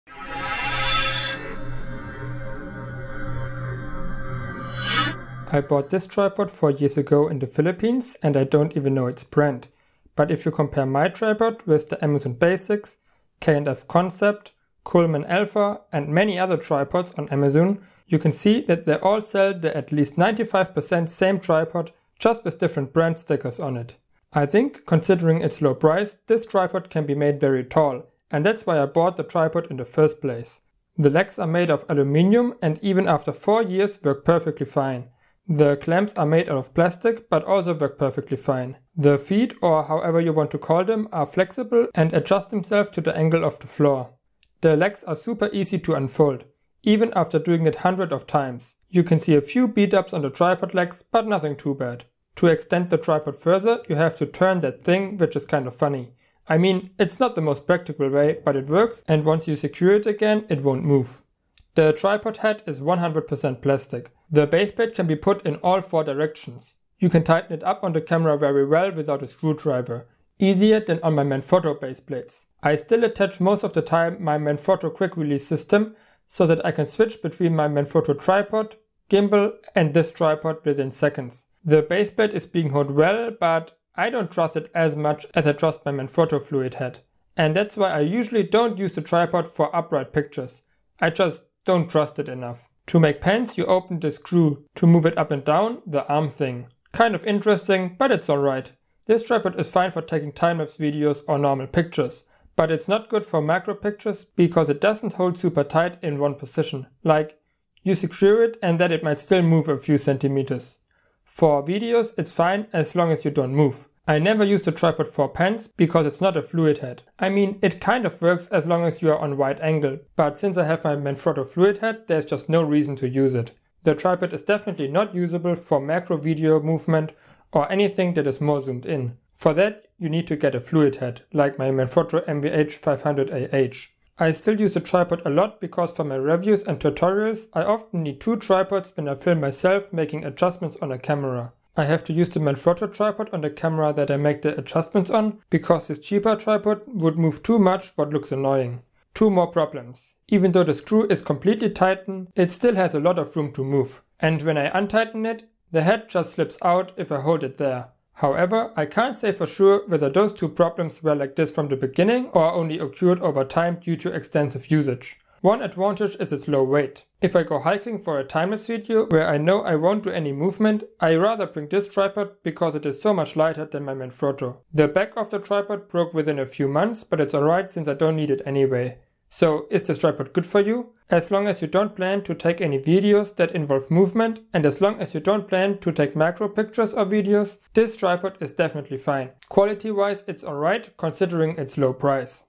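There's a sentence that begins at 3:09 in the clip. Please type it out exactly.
Quality wise it's alright considering its low price.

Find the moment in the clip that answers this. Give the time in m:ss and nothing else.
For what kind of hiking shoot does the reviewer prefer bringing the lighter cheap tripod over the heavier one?
2:48.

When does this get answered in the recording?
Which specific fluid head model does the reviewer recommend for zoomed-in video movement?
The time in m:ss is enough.
2:11.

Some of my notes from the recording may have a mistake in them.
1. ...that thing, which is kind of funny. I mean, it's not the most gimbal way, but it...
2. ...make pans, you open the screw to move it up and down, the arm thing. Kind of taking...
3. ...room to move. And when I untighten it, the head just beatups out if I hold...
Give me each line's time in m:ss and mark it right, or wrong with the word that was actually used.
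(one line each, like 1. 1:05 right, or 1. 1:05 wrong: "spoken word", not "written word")
1. 0:54 wrong: "practical", not "gimbal"
2. 1:32 wrong: "interesting", not "taking"
3. 2:33 wrong: "slips", not "beatups".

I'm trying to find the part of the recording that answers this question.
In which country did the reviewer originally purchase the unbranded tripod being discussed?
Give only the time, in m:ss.
0:07.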